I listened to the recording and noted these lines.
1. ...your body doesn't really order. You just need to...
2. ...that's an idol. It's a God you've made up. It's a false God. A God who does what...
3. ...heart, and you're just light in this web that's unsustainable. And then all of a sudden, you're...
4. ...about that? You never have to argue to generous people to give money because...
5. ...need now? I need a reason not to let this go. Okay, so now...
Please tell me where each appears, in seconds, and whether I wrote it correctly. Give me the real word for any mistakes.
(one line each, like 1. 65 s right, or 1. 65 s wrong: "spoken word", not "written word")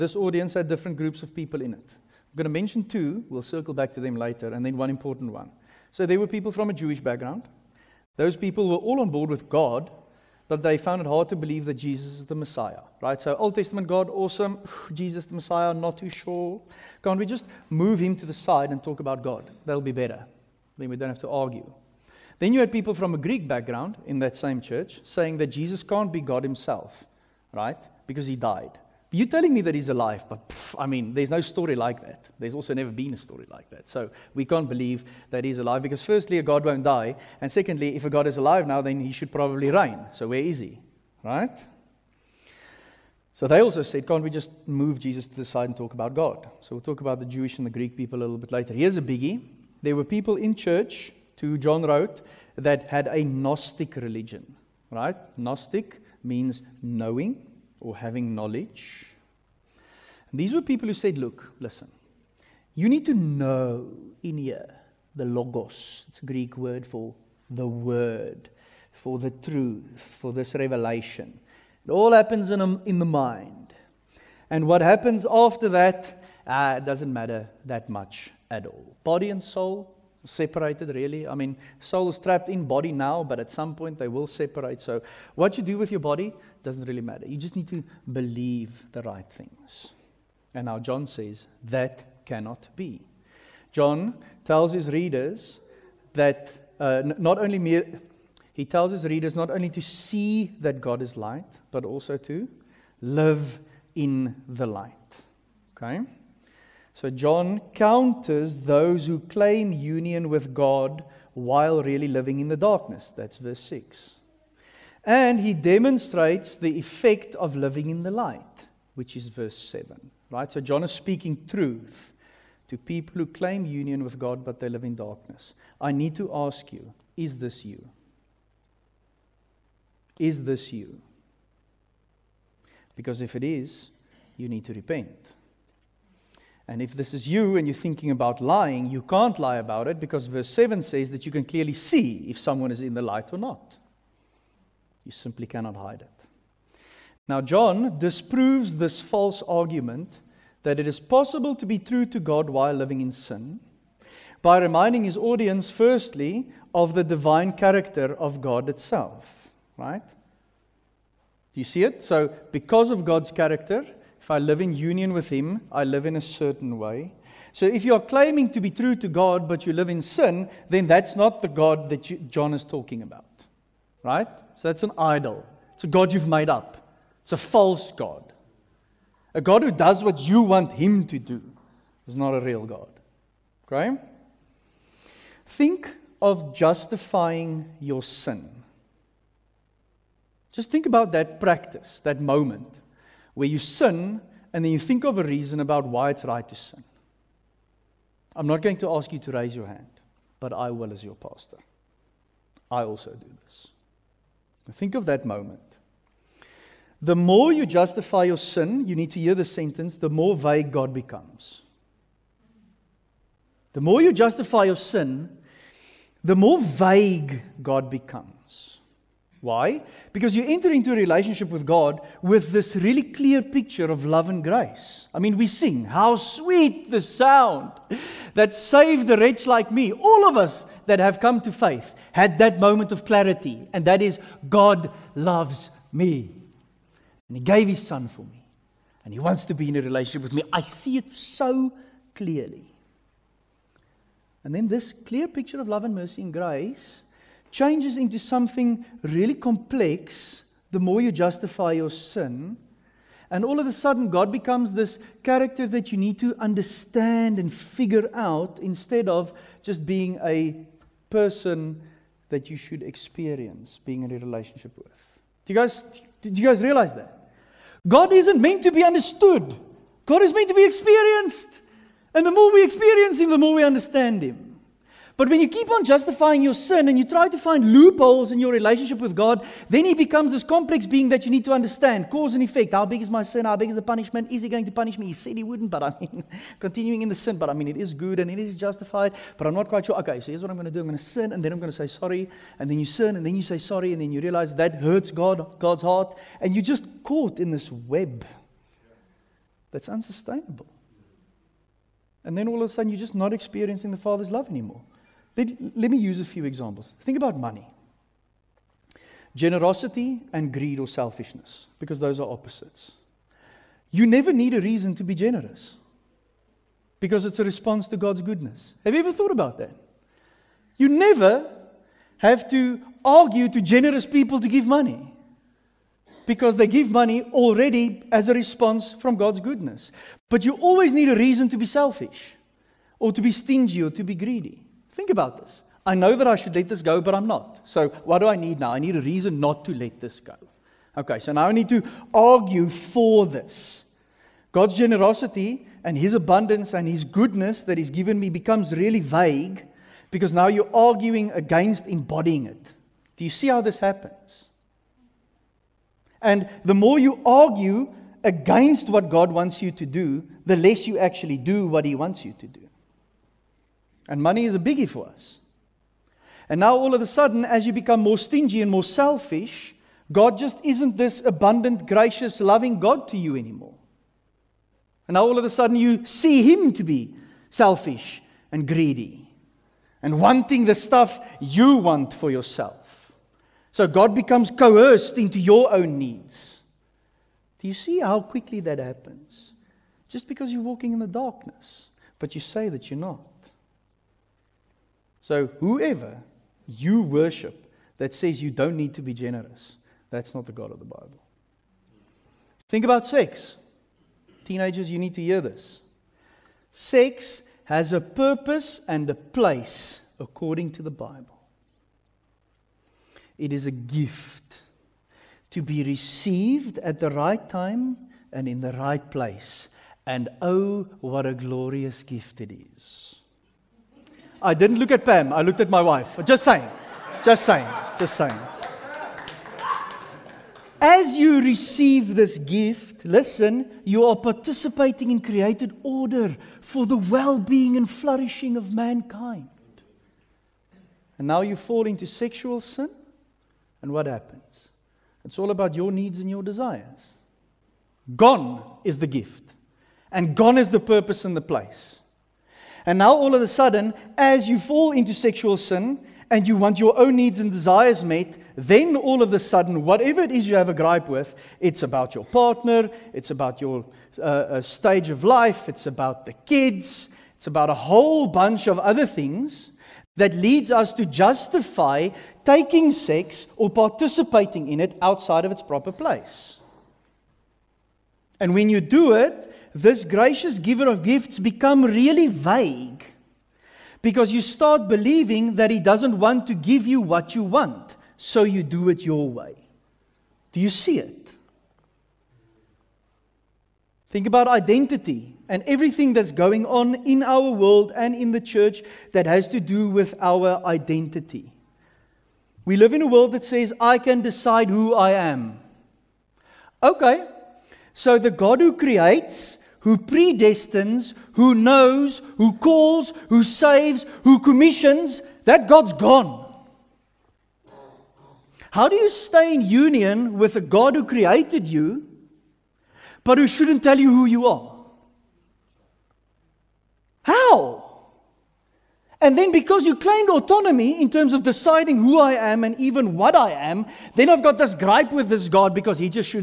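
1. 85 s wrong: "matter", not "order"
2. 174 s right
3. 295 s wrong: "caught", not "light"
4. 319 s right
5. 338 s right.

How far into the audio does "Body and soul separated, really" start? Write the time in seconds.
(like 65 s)
79 s.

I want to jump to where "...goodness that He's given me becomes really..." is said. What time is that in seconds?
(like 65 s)
347 s.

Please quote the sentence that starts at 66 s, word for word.
It's a Greek word for the word, for the truth, for this revelation.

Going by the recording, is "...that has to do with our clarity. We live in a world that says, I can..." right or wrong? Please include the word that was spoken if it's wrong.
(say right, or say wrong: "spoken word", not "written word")
wrong: "identity", not "clarity".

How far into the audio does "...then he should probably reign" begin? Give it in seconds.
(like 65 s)
38 s.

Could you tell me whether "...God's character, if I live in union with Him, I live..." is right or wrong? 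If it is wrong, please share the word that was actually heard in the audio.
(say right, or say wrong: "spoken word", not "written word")
right.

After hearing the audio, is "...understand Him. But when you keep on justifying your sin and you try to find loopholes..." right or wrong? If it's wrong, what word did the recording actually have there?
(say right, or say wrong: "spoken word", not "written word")
right.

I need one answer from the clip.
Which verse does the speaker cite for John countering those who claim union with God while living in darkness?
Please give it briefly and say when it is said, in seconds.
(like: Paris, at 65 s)
verse 6, at 113 s.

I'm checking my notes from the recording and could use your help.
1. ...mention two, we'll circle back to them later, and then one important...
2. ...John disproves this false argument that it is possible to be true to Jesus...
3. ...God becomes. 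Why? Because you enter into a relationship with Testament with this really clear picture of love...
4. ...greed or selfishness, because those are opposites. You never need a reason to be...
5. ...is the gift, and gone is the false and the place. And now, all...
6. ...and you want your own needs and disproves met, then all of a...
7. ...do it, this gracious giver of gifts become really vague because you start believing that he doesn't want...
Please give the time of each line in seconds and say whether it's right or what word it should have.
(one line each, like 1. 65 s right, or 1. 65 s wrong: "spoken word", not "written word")
1. 2 s right
2. 147 s wrong: "God", not "Jesus"
3. 217 s wrong: "God", not "Testament"
4. 310 s right
5. 448 s wrong: "purpose", not "false"
6. 456 s wrong: "desires", not "disproves"
7. 478 s right.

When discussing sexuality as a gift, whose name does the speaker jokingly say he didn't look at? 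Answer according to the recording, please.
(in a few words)
Pam.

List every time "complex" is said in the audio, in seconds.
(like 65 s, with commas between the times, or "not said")
249 s, 280 s.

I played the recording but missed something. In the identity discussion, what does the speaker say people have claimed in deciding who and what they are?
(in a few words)
autonomy.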